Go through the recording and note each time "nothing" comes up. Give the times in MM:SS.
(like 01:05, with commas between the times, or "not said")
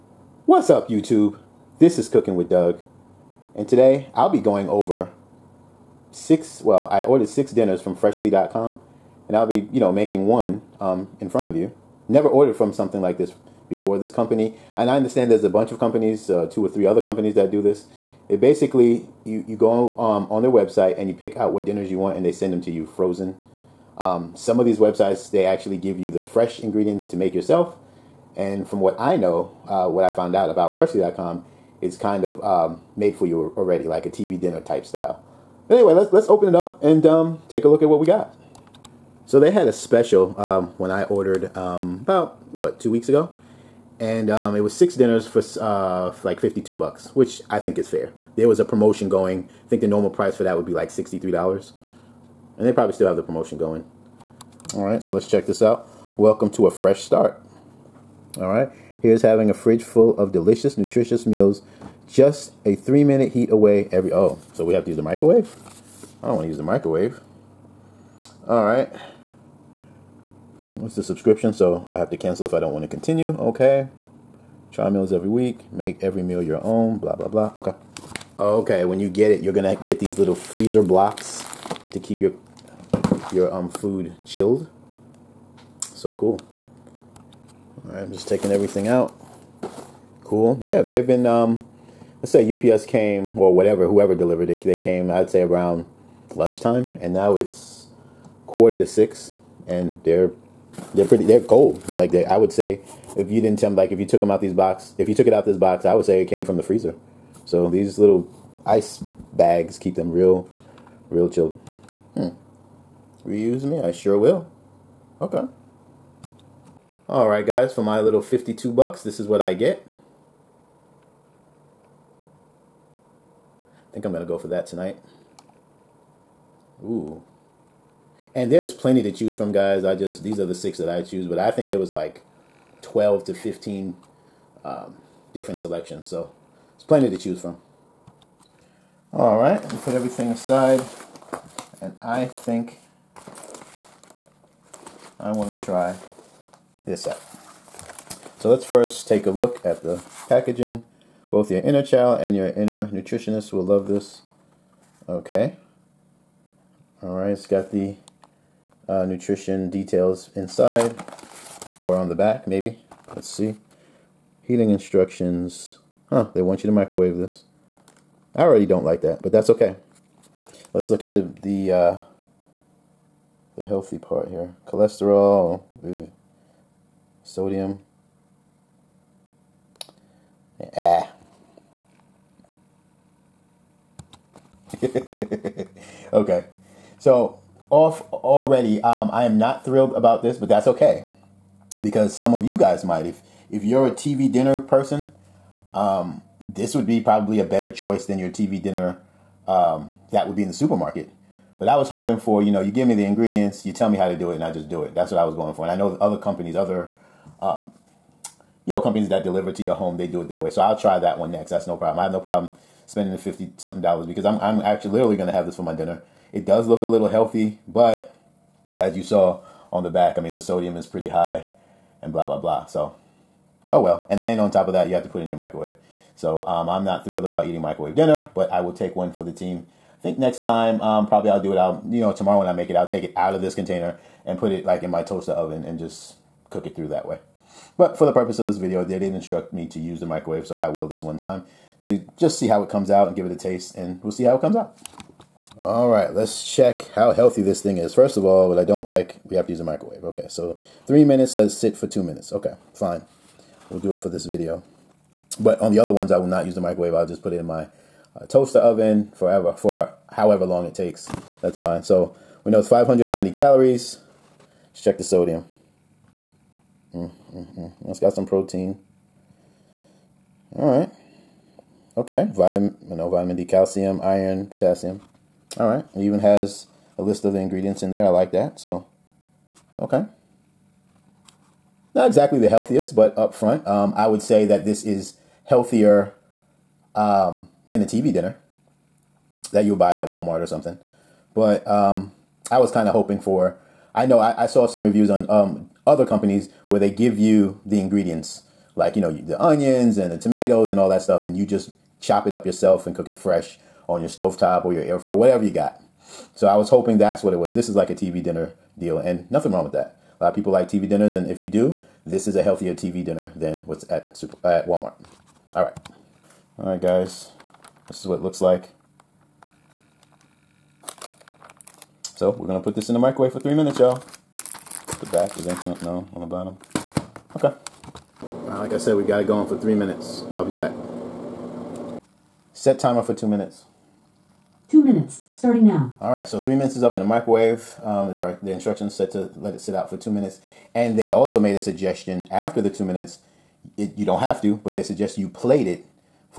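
05:09.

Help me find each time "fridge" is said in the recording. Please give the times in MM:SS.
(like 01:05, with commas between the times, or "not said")
00:59.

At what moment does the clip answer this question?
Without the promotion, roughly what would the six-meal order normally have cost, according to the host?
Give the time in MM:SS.
00:50.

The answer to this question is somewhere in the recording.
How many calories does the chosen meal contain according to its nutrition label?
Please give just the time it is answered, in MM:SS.
04:22.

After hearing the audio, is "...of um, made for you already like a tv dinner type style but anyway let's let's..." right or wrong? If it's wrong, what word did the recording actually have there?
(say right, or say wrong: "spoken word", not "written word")
right.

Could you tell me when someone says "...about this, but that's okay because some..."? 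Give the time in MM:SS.
03:09.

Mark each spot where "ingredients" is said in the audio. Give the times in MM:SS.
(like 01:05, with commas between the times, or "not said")
00:26, 03:23, 04:37, 04:57.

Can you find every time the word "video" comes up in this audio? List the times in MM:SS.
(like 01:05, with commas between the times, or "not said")
03:58, 04:14.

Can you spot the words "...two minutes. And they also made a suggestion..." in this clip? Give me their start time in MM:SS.
05:39.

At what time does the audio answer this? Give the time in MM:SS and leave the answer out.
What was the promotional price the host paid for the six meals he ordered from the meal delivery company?
00:46.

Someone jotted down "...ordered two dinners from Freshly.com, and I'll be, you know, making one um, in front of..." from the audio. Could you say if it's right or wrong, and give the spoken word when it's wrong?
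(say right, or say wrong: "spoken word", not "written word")
wrong: "six", not "two".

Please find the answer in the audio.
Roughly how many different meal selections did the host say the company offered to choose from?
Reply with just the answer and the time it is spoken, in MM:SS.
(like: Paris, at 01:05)
12 to 15, at 02:12.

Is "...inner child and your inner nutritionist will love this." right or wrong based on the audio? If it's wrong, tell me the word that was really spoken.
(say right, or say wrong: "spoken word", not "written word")
right.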